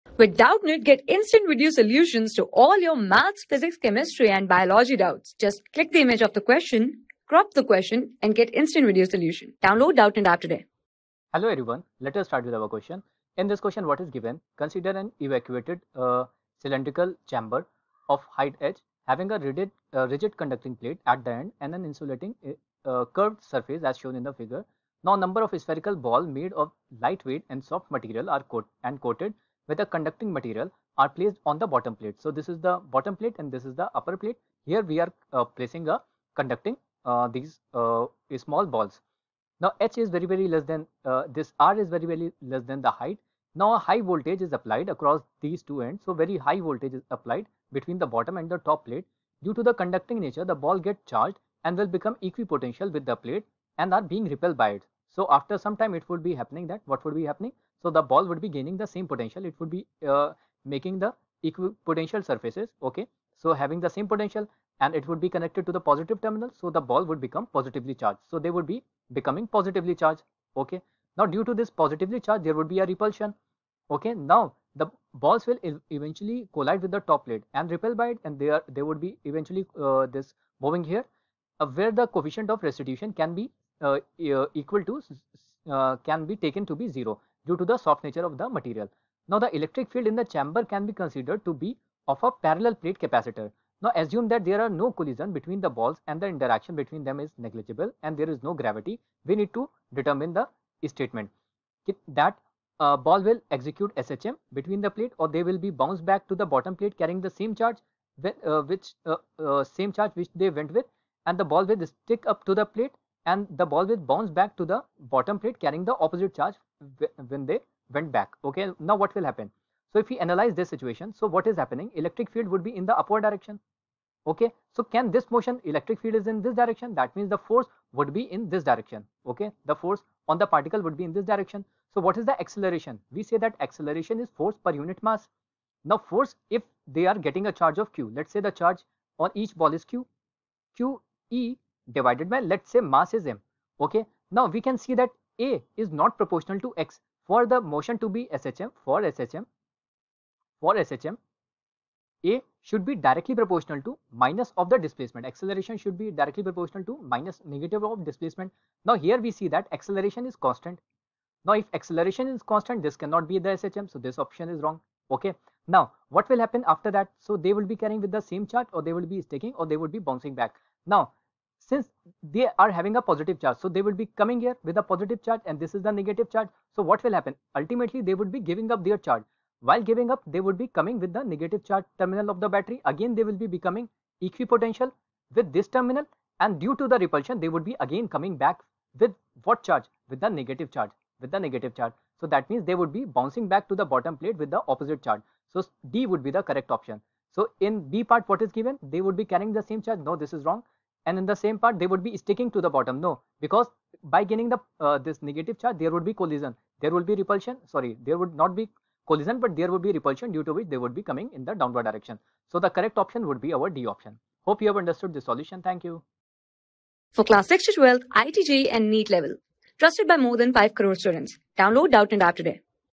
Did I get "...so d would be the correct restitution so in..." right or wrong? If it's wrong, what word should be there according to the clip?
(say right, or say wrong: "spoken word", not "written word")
wrong: "option", not "restitution".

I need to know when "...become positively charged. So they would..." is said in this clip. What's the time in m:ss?
1:07.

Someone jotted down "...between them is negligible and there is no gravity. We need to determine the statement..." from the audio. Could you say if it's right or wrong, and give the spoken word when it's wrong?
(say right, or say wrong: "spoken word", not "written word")
right.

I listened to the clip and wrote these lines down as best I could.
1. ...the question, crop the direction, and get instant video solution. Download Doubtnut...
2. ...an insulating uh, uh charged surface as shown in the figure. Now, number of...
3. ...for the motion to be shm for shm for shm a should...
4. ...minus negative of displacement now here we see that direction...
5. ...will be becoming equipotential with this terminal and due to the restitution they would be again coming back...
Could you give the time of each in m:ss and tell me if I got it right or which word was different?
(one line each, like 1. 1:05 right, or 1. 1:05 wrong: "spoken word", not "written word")
1. 0:06 wrong: "question", not "direction"
2. 0:21 wrong: "curved", not "charged"
3. 2:27 right
4. 2:37 wrong: "acceleration", not "direction"
5. 3:03 wrong: "repulsion", not "restitution".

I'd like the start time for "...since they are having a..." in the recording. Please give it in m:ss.
2:51.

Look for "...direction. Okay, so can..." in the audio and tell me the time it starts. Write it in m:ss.
2:03.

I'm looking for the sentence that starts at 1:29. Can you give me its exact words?
Now the electric field in the chamber can be considered to be of a parallel plate capacitor.